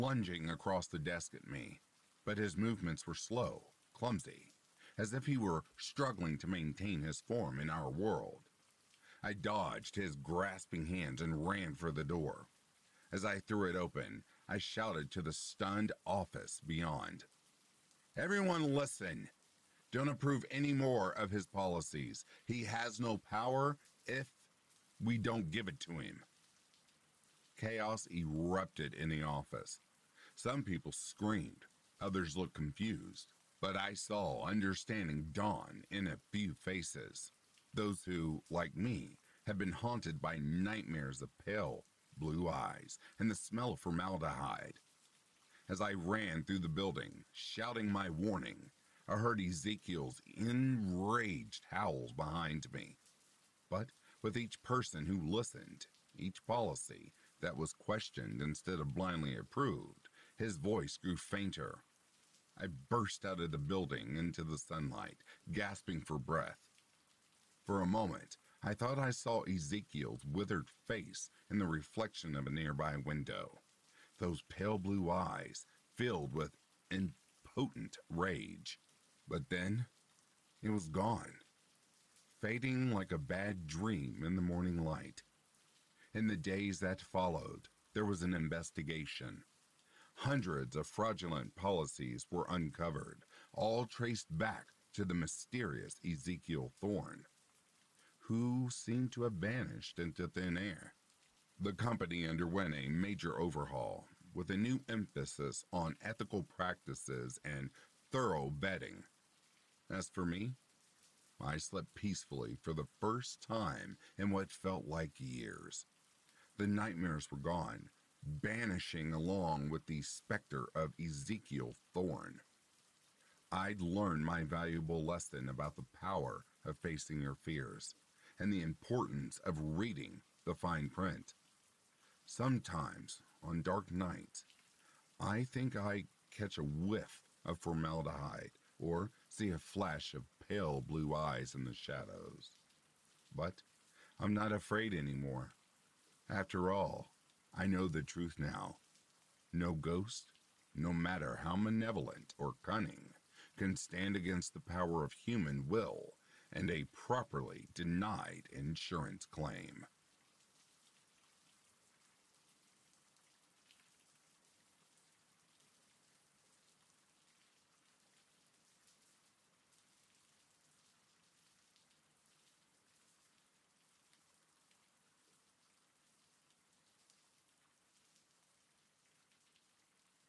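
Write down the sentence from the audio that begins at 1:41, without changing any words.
The company underwent a major overhaul with a new emphasis on ethical practices and thorough vetting.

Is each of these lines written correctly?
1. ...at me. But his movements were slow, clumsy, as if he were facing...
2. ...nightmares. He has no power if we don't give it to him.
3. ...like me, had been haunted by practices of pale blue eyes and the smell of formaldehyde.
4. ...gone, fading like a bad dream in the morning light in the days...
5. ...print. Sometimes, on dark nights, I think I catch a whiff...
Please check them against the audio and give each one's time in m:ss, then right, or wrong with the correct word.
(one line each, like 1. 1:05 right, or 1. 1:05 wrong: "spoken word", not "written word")
1. 0:01 wrong: "struggling", not "facing"
2. 0:21 wrong: "policies", not "nightmares"
3. 0:38 wrong: "nightmares", not "practices"
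4. 1:20 right
5. 2:10 right.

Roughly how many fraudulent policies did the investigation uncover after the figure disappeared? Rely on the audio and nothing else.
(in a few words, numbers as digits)
Hundreds.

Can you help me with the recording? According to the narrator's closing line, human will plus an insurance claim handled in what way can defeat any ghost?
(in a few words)
properly denied.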